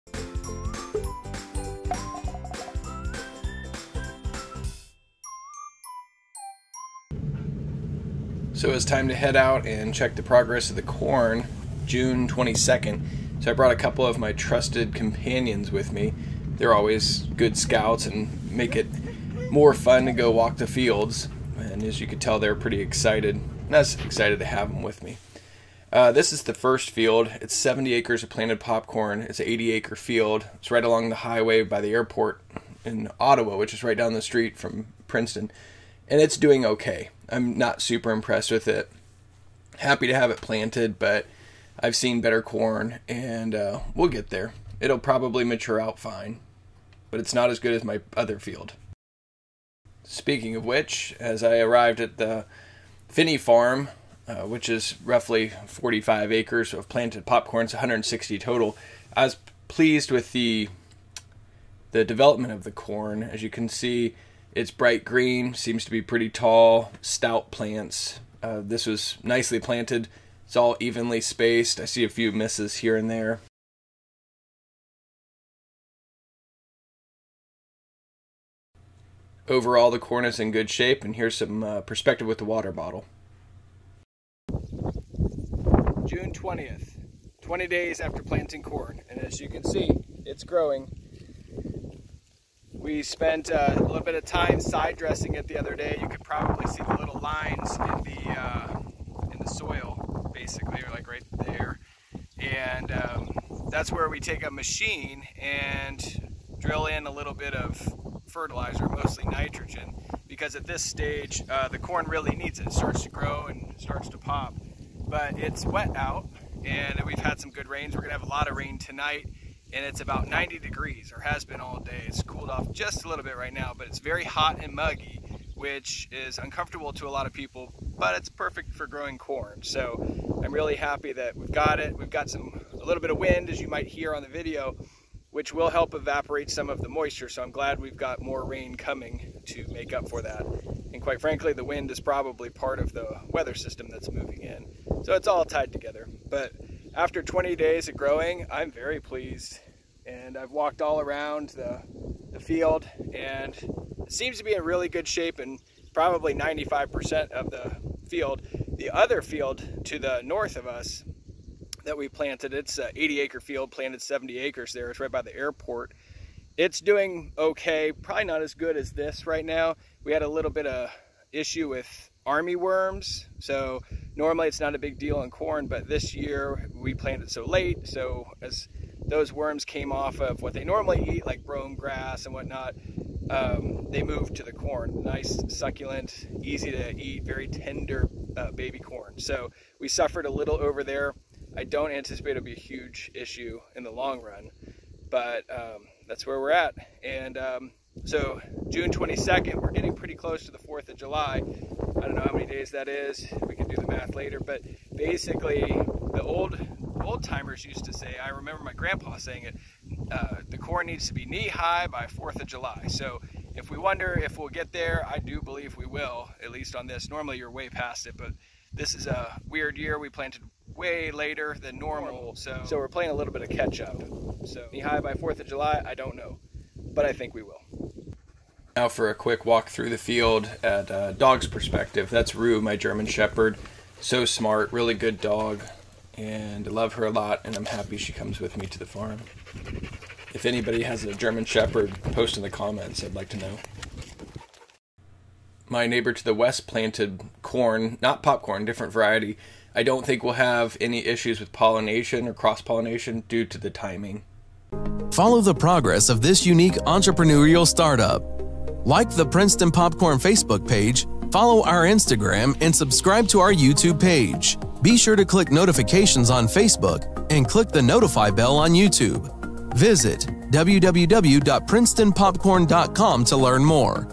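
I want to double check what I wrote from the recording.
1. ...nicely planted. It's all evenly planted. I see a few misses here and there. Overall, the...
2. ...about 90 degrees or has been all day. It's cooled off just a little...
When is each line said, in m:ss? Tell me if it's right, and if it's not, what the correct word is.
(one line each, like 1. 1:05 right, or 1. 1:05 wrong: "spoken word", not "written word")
1. 1:09 wrong: "spaced", not "planted"
2. 2:00 right.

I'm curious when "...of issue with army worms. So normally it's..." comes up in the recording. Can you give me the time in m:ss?
2:50.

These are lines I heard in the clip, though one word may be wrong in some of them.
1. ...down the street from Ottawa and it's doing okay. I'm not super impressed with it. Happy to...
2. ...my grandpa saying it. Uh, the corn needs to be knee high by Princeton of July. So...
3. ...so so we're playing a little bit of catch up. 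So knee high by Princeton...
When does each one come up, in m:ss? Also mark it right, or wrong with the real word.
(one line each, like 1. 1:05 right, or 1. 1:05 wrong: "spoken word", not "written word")
1. 0:33 wrong: "Princeton", not "Ottawa"
2. 3:28 wrong: "Fourth", not "Princeton"
3. 3:42 wrong: "Fourth", not "Princeton".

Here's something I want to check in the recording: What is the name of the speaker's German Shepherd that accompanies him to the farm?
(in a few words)
Rue.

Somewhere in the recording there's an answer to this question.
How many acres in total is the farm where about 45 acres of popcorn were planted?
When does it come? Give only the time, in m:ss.
0:57.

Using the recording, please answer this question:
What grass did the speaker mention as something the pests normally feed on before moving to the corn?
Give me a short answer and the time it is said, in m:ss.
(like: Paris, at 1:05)
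Brome grass, at 3:01.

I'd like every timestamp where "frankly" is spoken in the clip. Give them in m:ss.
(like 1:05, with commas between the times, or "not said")
2:21.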